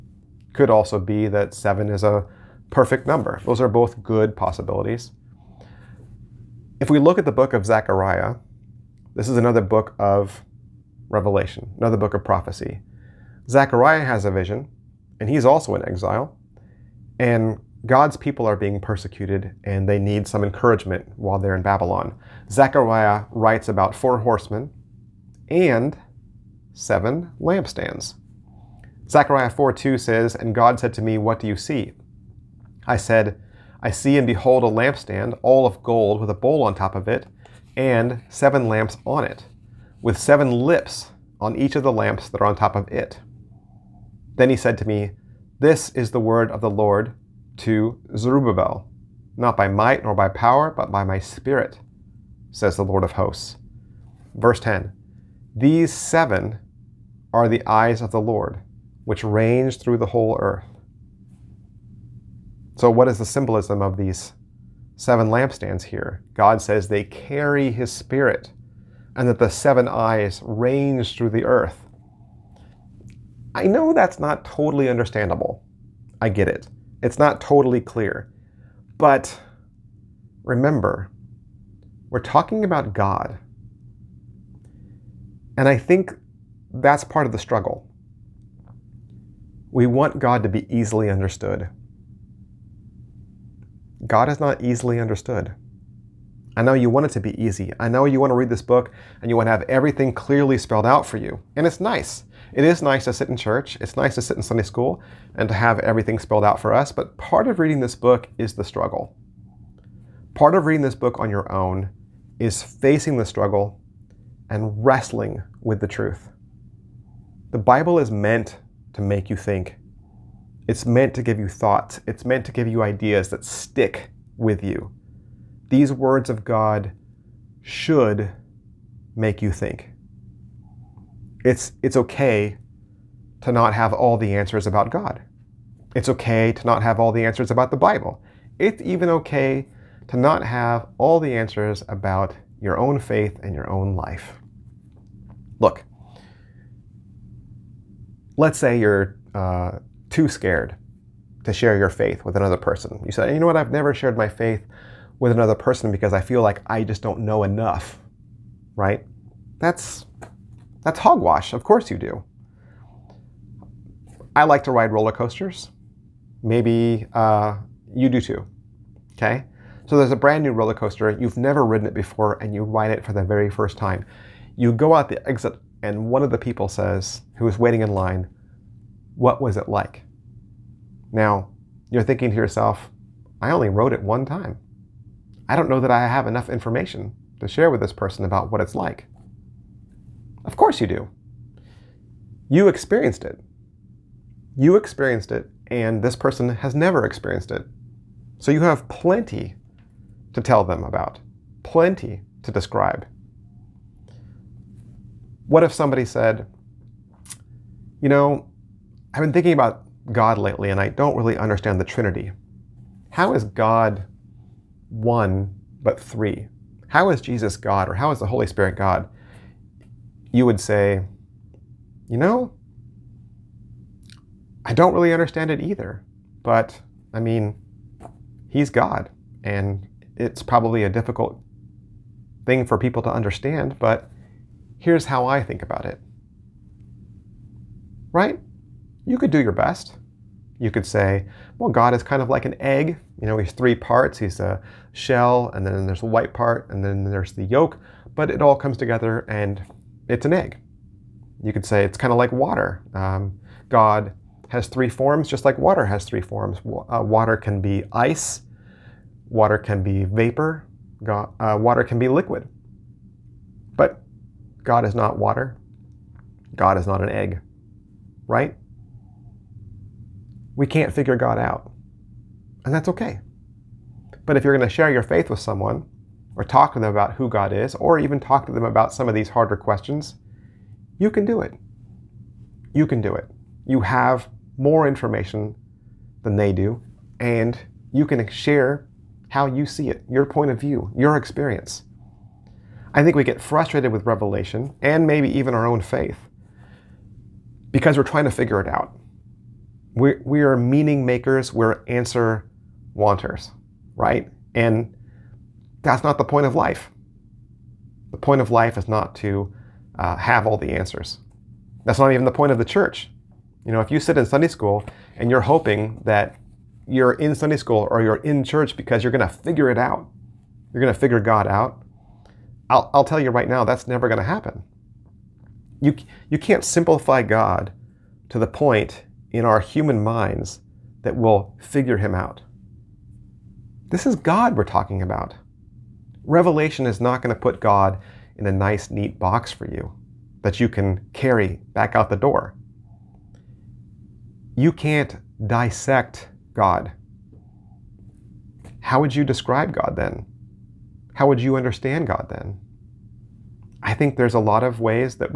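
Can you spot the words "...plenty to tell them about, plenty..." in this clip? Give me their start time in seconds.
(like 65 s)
198 s.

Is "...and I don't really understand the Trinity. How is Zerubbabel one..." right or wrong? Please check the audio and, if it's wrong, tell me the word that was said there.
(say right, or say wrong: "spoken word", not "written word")
wrong: "God", not "Zerubbabel".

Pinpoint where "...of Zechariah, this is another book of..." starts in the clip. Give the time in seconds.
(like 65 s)
7 s.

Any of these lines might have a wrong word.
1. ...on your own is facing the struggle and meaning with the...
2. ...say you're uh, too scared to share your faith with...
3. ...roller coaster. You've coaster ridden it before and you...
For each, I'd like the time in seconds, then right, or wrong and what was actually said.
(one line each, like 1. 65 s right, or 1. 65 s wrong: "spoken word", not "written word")
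1. 111 s wrong: "wrestling", not "meaning"
2. 148 s right
3. 170 s wrong: "never", not "coaster".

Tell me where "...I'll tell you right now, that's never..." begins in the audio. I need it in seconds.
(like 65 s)
322 s.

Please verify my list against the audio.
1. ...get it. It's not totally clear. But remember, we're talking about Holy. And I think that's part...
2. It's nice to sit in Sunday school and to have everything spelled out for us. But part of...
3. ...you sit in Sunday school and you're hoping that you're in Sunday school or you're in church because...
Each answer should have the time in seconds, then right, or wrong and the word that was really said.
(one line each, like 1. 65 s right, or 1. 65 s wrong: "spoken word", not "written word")
1. 76 s wrong: "God", not "Holy"
2. 103 s right
3. 313 s right.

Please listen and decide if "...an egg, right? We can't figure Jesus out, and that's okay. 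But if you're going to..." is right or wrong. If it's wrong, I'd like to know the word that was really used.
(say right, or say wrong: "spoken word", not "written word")
wrong: "God", not "Jesus".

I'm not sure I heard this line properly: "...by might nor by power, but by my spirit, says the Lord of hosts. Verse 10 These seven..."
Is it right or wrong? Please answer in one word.
right.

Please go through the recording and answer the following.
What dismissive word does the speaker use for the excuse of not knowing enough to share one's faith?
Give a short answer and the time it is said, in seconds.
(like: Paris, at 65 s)
hogwash, at 160 s.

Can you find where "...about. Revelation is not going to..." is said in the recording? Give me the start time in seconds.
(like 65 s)
335 s.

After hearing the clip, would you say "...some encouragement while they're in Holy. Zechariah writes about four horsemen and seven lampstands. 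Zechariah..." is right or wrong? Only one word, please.
wrong.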